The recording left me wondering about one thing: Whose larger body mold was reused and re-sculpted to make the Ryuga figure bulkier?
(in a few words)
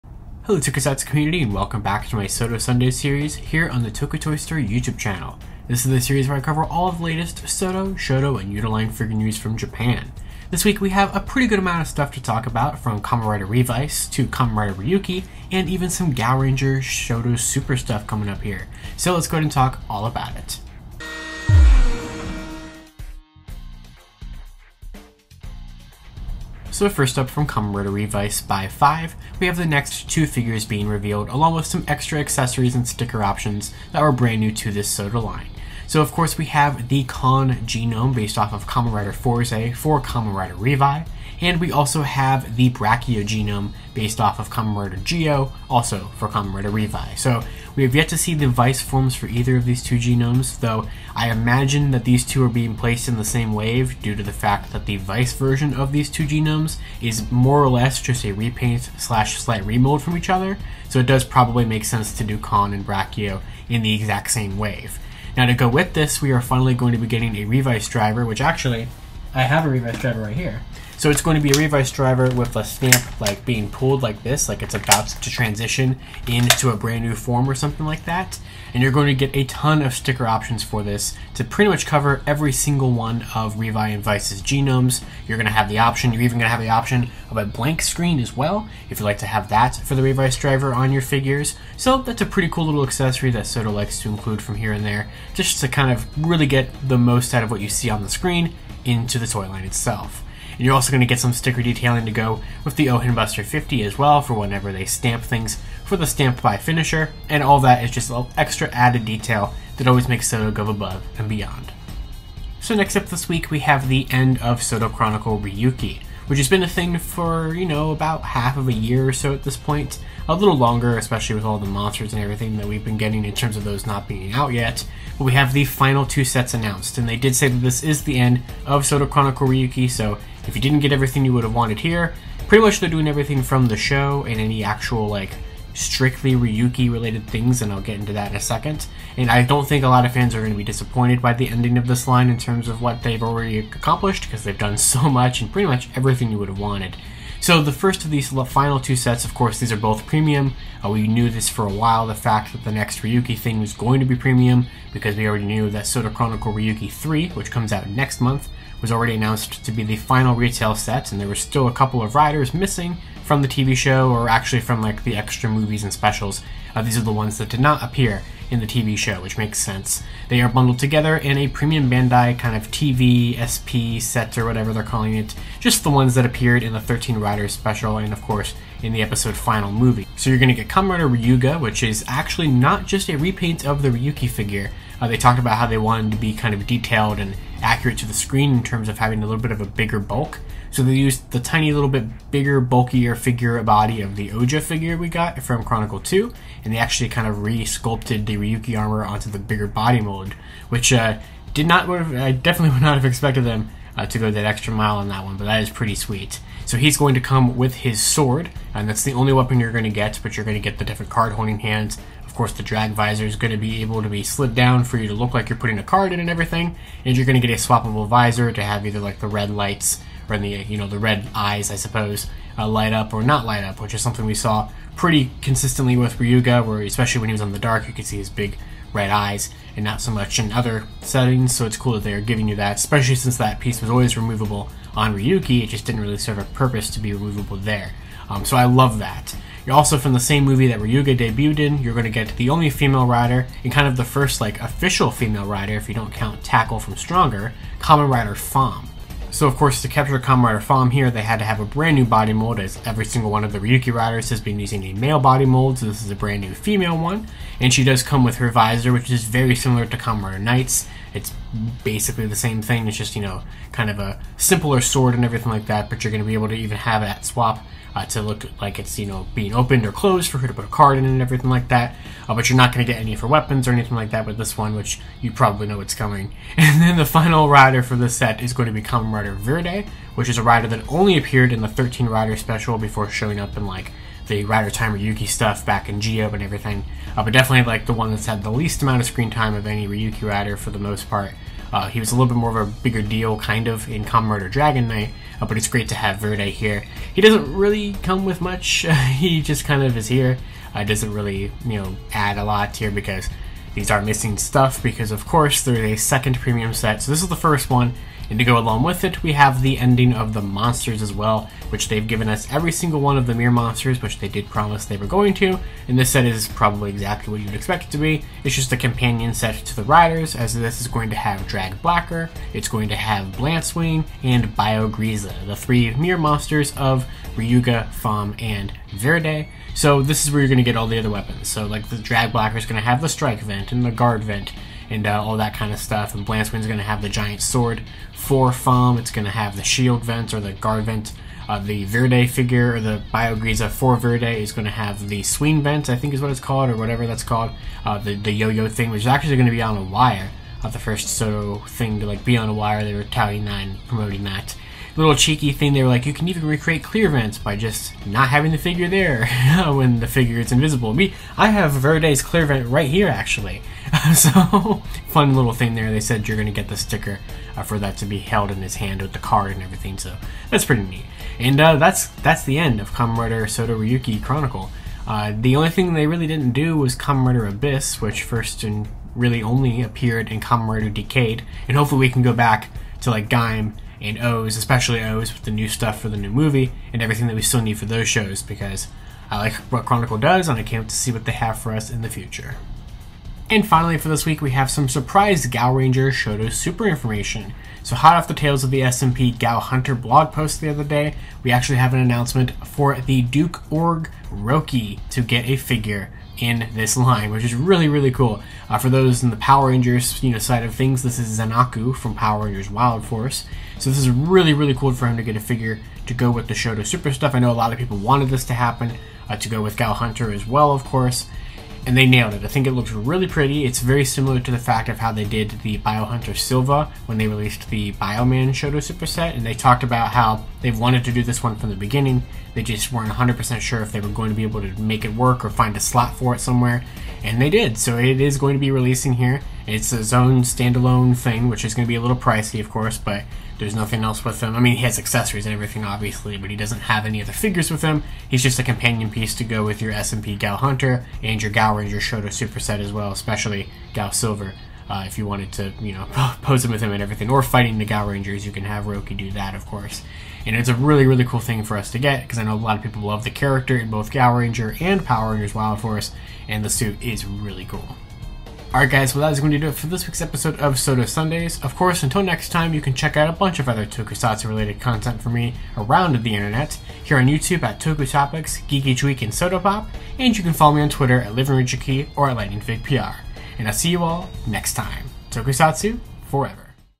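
Ouja.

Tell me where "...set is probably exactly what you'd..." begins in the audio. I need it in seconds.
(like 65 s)
316 s.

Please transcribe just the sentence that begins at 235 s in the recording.
It just didn't really serve a purpose to be removable there.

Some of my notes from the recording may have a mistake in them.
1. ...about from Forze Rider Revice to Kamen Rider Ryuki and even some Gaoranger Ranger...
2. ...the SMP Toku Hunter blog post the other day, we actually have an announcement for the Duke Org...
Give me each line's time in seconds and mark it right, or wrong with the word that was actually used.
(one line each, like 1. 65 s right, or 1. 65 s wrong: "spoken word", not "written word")
1. 12 s wrong: "Kamen", not "Forze"
2. 398 s wrong: "Gao", not "Toku".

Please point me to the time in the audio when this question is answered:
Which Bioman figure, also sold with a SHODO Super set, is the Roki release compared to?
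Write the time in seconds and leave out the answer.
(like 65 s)
425 s.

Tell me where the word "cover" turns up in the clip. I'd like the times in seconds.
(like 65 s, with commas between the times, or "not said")
6 s, 81 s.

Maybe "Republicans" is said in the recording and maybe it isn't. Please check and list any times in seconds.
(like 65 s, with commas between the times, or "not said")
not said.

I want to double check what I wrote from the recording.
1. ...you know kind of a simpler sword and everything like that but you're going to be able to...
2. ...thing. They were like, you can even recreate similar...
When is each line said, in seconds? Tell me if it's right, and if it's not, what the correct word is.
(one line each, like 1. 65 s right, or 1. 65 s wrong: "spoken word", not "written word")
1. 263 s right
2. 355 s wrong: "clear", not "similar".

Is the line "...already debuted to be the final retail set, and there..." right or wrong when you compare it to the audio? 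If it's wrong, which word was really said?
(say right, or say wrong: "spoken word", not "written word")
wrong: "announced", not "debuted".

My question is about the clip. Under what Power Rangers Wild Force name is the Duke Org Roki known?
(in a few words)
Zen-Aku.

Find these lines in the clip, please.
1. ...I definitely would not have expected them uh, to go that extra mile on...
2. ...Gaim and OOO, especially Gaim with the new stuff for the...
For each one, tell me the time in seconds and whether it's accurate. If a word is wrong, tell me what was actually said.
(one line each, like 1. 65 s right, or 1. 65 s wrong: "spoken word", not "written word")
1. 201 s right
2. 383 s wrong: "OOO", not "Gaim".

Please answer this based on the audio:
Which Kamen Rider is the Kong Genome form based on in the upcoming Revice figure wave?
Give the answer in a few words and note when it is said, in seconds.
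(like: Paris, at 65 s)
Kamen Rider Forze, at 38 s.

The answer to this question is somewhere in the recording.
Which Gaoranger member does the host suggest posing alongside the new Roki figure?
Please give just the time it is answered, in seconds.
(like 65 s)
453 s.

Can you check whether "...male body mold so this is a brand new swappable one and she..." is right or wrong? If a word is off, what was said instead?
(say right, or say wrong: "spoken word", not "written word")
wrong: "female", not "swappable".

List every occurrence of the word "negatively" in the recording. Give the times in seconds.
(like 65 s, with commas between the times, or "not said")
not said.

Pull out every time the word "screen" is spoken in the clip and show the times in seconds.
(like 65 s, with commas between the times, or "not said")
87 s, 98 s, 188 s, 289 s.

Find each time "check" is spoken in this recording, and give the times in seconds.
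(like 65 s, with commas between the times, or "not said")
472 s.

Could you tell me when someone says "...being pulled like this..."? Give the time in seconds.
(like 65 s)
73 s.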